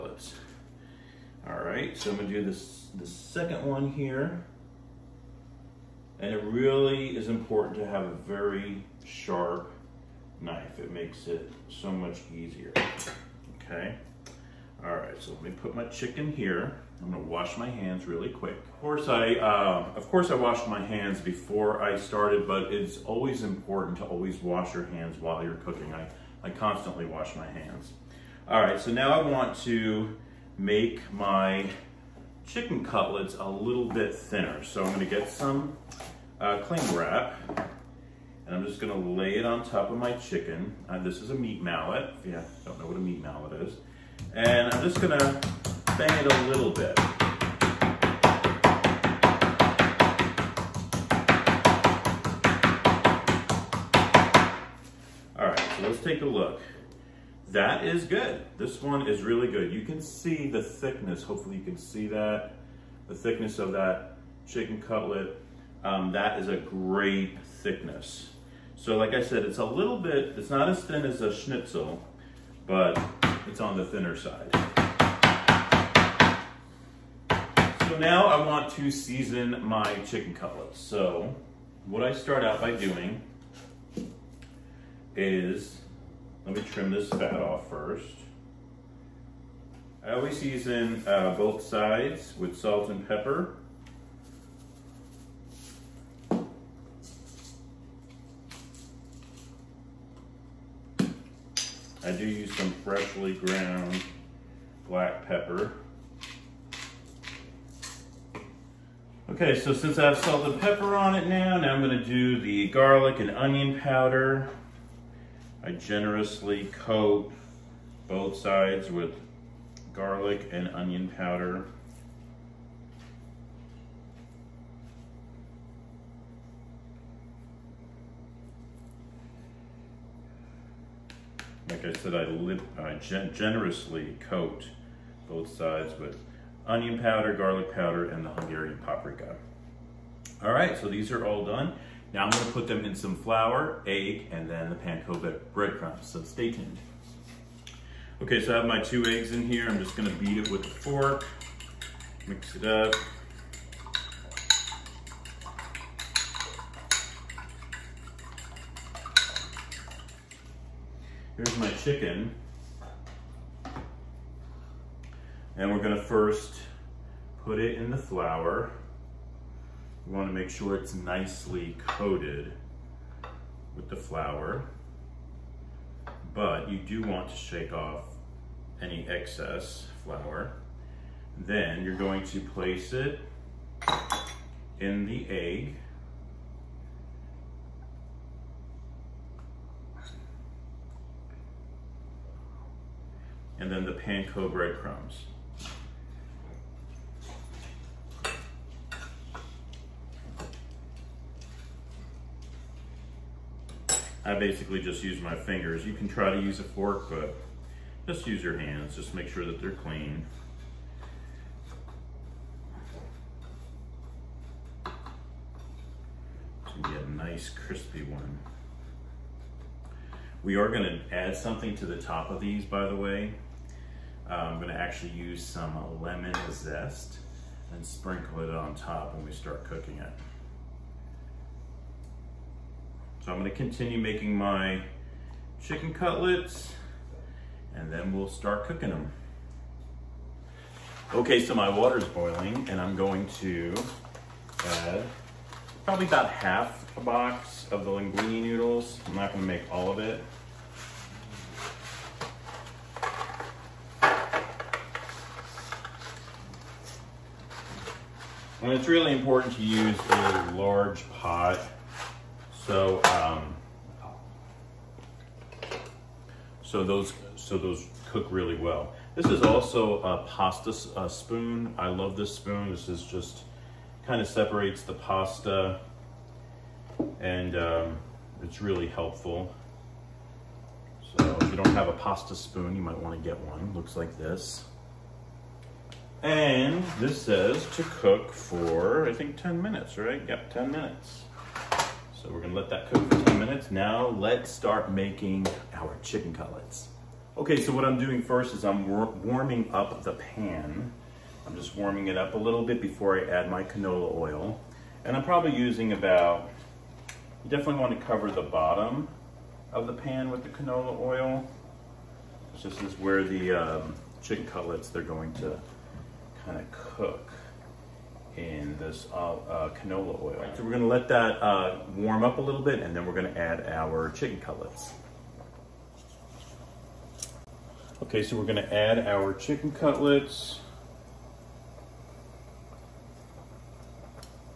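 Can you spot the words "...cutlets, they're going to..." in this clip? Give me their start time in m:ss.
5:14.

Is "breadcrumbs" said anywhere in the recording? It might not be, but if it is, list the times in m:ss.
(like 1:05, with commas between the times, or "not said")
2:25, 3:14.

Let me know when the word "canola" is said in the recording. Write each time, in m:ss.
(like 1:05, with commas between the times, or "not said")
5:03, 5:10, 5:19.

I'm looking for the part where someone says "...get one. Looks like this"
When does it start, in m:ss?
4:43.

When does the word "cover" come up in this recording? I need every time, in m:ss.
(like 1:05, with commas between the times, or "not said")
5:08.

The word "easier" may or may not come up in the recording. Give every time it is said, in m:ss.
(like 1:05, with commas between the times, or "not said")
0:12.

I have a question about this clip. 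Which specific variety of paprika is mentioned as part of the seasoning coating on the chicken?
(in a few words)
Hungarian.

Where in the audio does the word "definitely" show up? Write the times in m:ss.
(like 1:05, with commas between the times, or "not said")
5:07.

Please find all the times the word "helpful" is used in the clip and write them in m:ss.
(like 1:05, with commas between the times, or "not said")
4:38.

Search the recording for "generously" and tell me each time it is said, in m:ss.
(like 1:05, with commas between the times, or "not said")
1:55, 2:13.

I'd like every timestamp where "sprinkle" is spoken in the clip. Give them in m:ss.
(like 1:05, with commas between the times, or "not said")
3:47.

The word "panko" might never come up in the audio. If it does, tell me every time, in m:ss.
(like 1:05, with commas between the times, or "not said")
2:24, 3:13.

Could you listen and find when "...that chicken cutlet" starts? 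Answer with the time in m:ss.
1:03.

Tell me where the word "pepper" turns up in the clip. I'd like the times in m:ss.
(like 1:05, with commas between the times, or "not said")
1:33, 1:45, 1:50.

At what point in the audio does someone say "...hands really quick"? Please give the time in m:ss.
0:17.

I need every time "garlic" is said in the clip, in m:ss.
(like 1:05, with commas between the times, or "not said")
1:52, 1:59, 2:17.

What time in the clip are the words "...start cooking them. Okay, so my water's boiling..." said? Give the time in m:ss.
3:58.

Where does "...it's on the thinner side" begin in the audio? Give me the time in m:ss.
1:13.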